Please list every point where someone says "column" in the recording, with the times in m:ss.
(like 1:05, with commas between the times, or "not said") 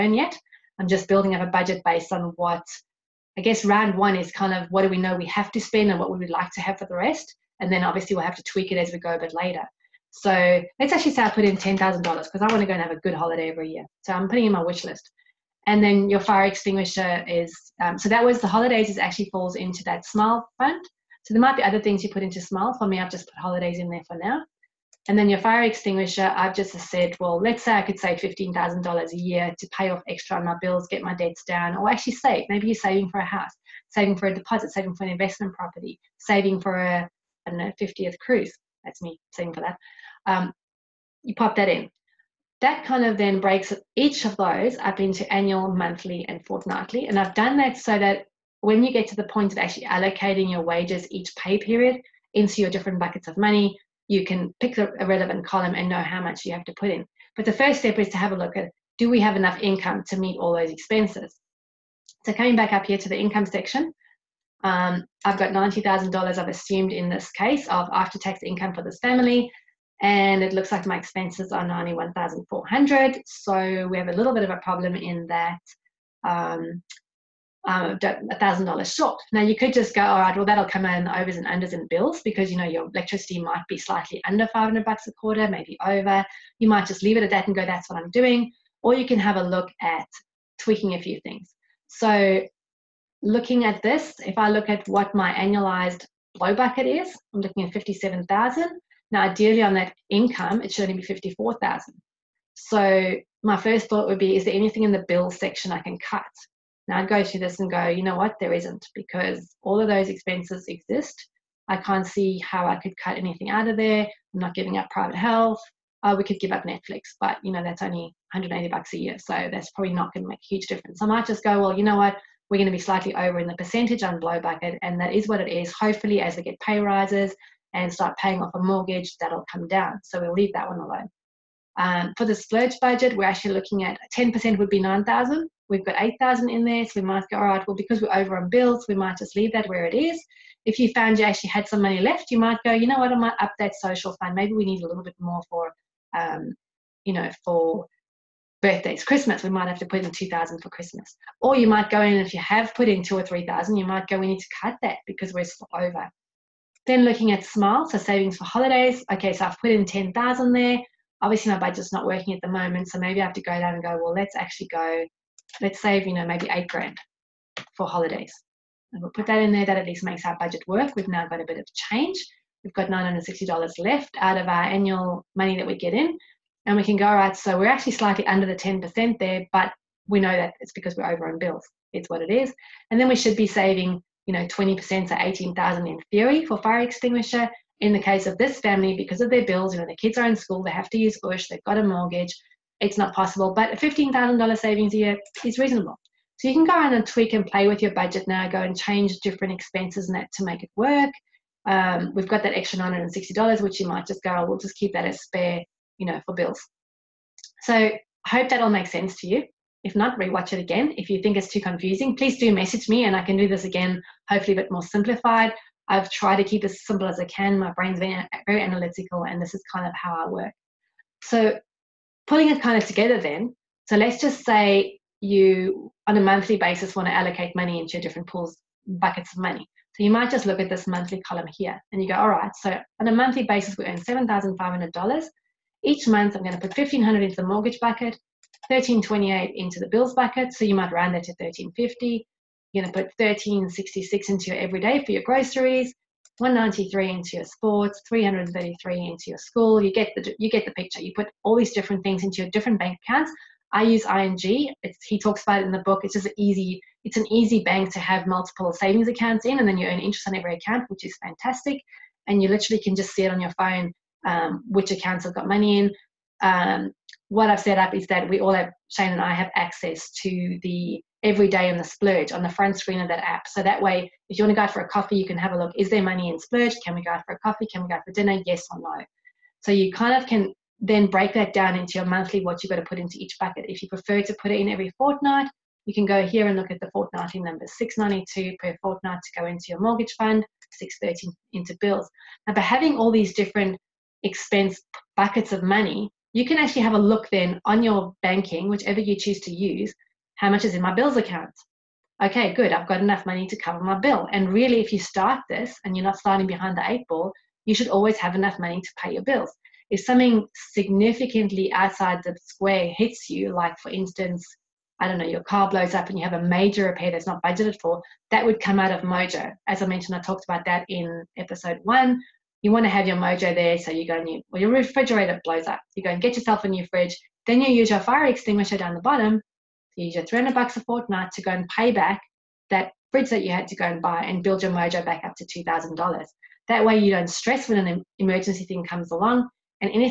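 0:55, 3:51.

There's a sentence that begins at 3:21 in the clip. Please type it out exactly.
Um, we've got that extra $960, which you might just go, oh, we'll just keep that as spare, you know, for bills.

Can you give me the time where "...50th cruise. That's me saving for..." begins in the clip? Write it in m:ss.
0:37.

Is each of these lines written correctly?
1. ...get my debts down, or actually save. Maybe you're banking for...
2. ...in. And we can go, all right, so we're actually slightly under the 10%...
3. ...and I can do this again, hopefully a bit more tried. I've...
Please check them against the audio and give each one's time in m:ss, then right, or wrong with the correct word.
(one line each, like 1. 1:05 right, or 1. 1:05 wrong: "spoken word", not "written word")
1. 0:30 wrong: "saving", not "banking"
2. 2:55 right
3. 3:33 wrong: "simplified", not "tried".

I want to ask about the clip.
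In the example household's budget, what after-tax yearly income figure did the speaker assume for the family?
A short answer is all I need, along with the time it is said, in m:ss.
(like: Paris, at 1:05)
$90,000, at 1:05.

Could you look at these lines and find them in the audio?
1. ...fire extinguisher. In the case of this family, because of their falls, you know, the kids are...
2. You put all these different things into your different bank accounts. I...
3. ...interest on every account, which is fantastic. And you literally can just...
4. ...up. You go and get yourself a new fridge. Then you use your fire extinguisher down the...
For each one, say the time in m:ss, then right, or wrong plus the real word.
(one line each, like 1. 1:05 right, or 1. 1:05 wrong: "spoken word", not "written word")
1. 3:06 wrong: "bills", not "falls"
2. 4:11 right
3. 4:19 right
4. 5:25 right.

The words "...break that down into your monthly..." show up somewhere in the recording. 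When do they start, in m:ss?
4:41.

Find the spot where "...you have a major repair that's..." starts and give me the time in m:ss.
5:16.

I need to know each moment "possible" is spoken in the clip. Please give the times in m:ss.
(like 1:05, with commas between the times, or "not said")
3:13.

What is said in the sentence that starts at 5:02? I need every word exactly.
Okay, good, I've got enough money to cover my bill.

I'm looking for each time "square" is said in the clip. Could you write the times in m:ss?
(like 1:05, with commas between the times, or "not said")
5:12.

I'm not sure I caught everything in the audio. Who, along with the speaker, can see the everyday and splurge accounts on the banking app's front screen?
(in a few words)
Shane.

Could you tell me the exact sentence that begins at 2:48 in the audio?
And we'll put that in there.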